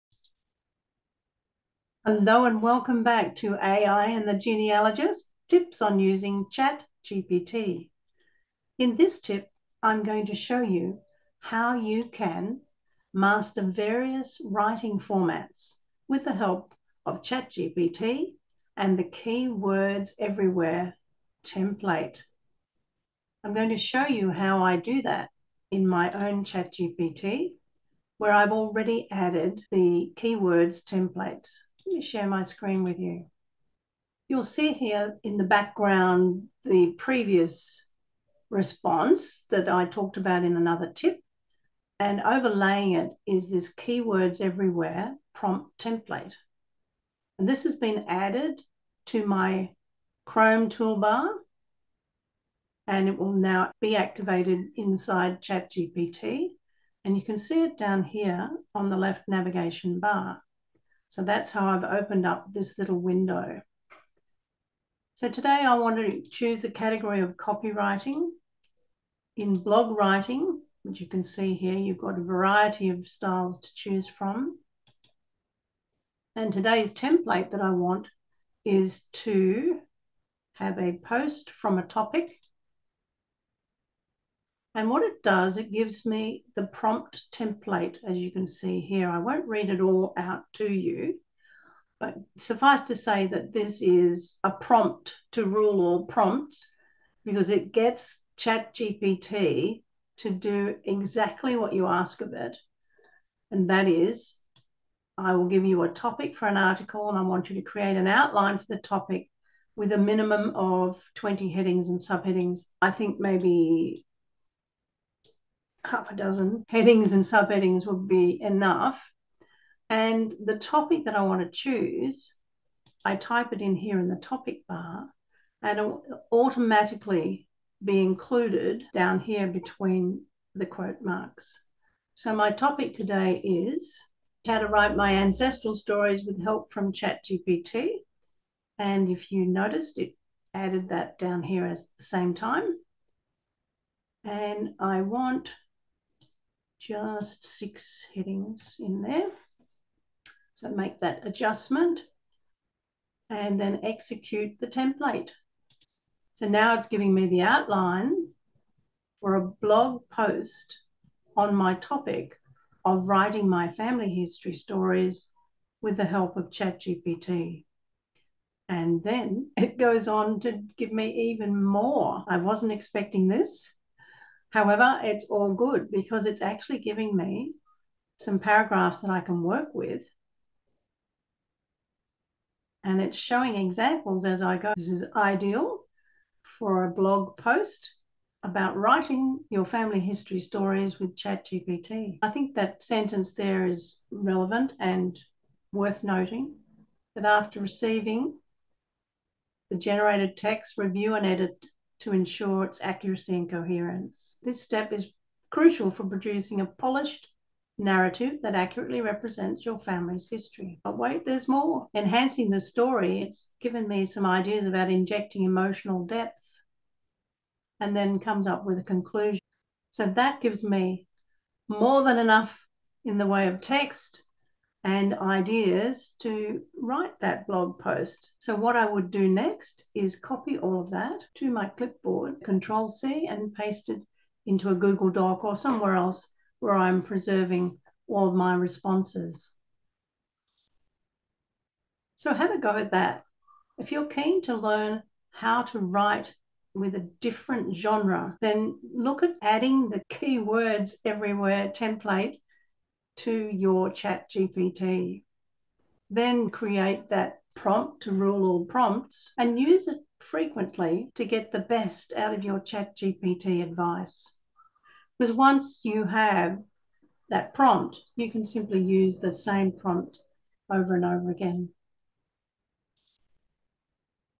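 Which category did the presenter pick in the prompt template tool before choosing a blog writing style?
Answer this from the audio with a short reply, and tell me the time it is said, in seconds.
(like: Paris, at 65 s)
Copywriting, at 67 s.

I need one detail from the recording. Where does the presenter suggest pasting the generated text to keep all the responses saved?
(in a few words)
A Google Doc.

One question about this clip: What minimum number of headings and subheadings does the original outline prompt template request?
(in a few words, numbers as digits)
20.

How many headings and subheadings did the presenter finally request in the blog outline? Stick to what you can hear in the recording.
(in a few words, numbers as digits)
6.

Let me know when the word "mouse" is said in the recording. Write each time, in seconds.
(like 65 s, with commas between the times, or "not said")
not said.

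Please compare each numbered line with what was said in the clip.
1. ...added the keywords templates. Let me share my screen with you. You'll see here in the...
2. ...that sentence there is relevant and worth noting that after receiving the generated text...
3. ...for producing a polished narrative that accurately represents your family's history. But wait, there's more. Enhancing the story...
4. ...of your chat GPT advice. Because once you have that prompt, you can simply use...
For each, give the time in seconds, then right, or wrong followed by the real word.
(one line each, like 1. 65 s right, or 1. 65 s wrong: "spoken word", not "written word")
1. 29 s right
2. 192 s right
3. 205 s right
4. 262 s right.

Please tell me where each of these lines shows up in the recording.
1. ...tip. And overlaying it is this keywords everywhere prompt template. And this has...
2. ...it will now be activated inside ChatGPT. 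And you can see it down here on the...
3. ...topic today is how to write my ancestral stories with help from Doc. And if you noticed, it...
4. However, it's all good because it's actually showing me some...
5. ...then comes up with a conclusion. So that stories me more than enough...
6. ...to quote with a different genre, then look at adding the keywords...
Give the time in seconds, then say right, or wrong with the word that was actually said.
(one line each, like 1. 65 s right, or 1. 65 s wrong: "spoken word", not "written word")
1. 40 s right
2. 53 s right
3. 132 s wrong: "ChatGPT", not "Doc"
4. 174 s wrong: "giving", not "showing"
5. 217 s wrong: "gives", not "stories"
6. 245 s wrong: "write", not "quote".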